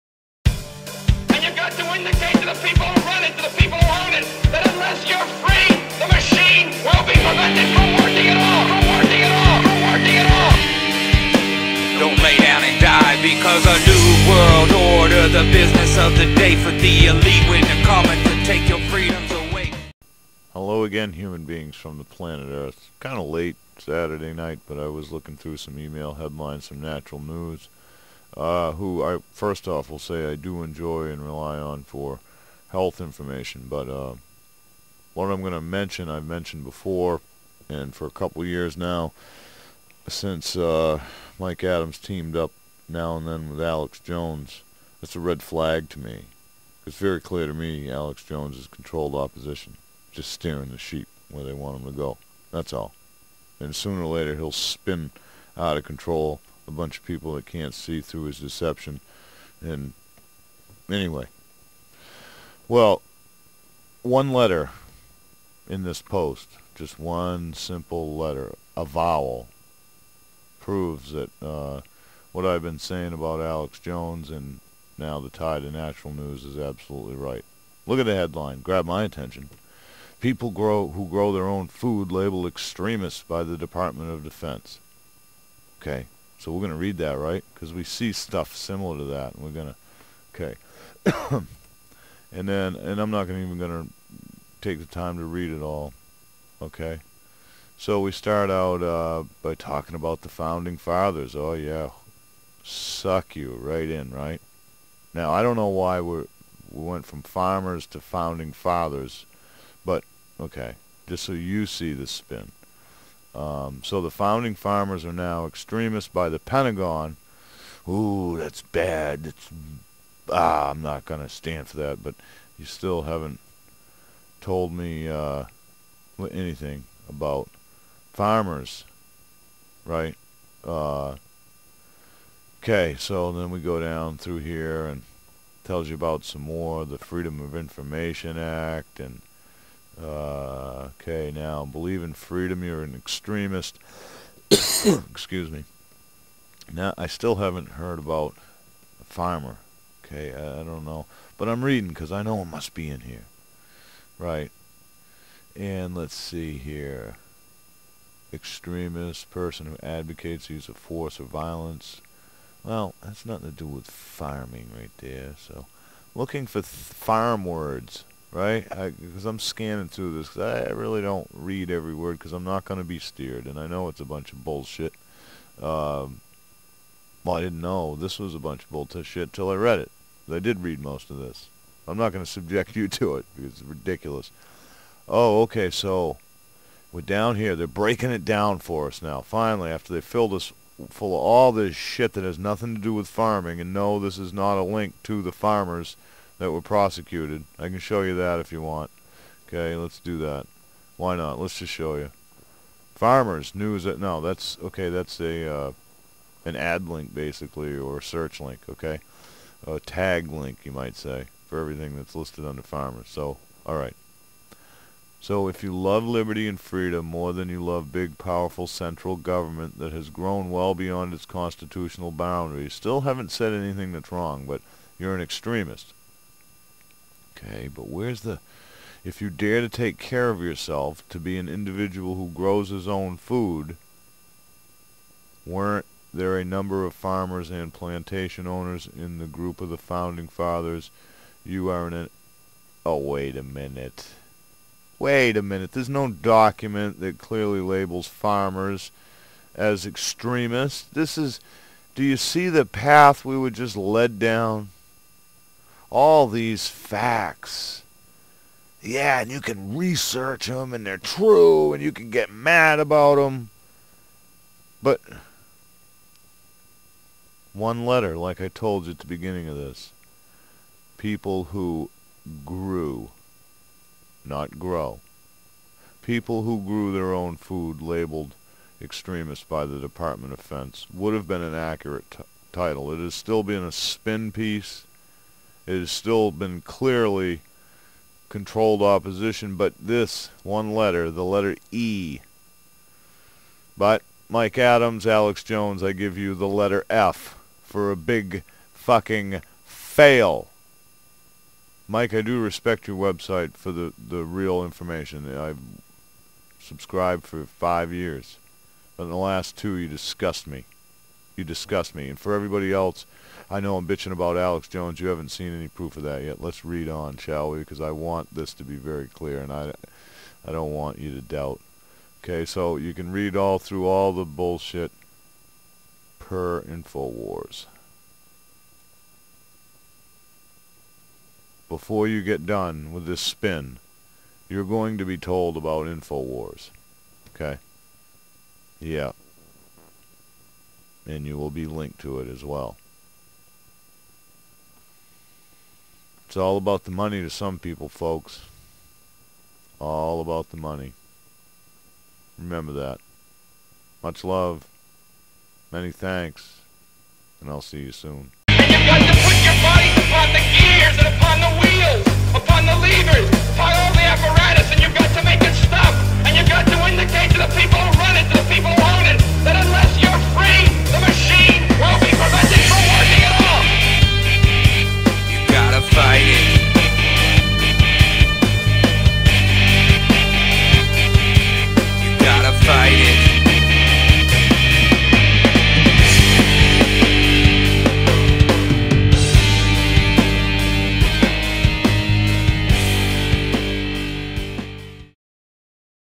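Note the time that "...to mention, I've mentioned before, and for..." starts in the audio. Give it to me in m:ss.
0:35.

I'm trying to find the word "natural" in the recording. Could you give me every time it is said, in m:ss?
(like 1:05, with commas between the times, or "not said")
0:26, 1:15.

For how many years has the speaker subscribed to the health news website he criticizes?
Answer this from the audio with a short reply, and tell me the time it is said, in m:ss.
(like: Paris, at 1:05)
5, at 5:07.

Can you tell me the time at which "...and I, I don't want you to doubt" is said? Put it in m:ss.
5:19.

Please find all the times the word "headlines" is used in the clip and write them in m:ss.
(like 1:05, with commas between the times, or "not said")
0:26, 1:18.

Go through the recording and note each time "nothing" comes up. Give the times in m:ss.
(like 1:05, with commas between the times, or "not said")
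2:43, 3:12.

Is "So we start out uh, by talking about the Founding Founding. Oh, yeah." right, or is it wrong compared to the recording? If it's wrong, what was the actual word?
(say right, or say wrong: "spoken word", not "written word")
wrong: "Fathers", not "Founding".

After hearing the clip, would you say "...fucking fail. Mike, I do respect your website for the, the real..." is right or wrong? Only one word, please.
right.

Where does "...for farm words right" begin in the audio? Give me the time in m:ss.
2:46.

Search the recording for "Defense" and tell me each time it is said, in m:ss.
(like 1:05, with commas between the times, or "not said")
1:24, 4:40.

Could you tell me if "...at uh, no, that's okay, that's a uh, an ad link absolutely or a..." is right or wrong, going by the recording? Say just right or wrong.
wrong.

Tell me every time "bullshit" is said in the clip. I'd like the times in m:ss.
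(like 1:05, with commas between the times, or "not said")
2:54, 2:58, 5:24.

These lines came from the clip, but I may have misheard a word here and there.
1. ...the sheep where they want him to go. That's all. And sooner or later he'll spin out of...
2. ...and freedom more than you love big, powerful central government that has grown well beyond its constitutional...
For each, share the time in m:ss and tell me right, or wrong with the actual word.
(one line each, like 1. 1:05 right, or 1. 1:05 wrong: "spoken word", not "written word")
1. 0:50 right
2. 3:36 right.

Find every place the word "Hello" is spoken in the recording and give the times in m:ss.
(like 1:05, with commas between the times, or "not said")
0:20.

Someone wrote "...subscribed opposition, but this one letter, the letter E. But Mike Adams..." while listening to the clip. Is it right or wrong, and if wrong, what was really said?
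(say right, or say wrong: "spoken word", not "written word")
wrong: "controlled", not "subscribed".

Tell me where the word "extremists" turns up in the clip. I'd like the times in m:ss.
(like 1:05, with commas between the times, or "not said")
1:22, 1:55, 2:22, 2:38, 3:45, 4:09, 4:38.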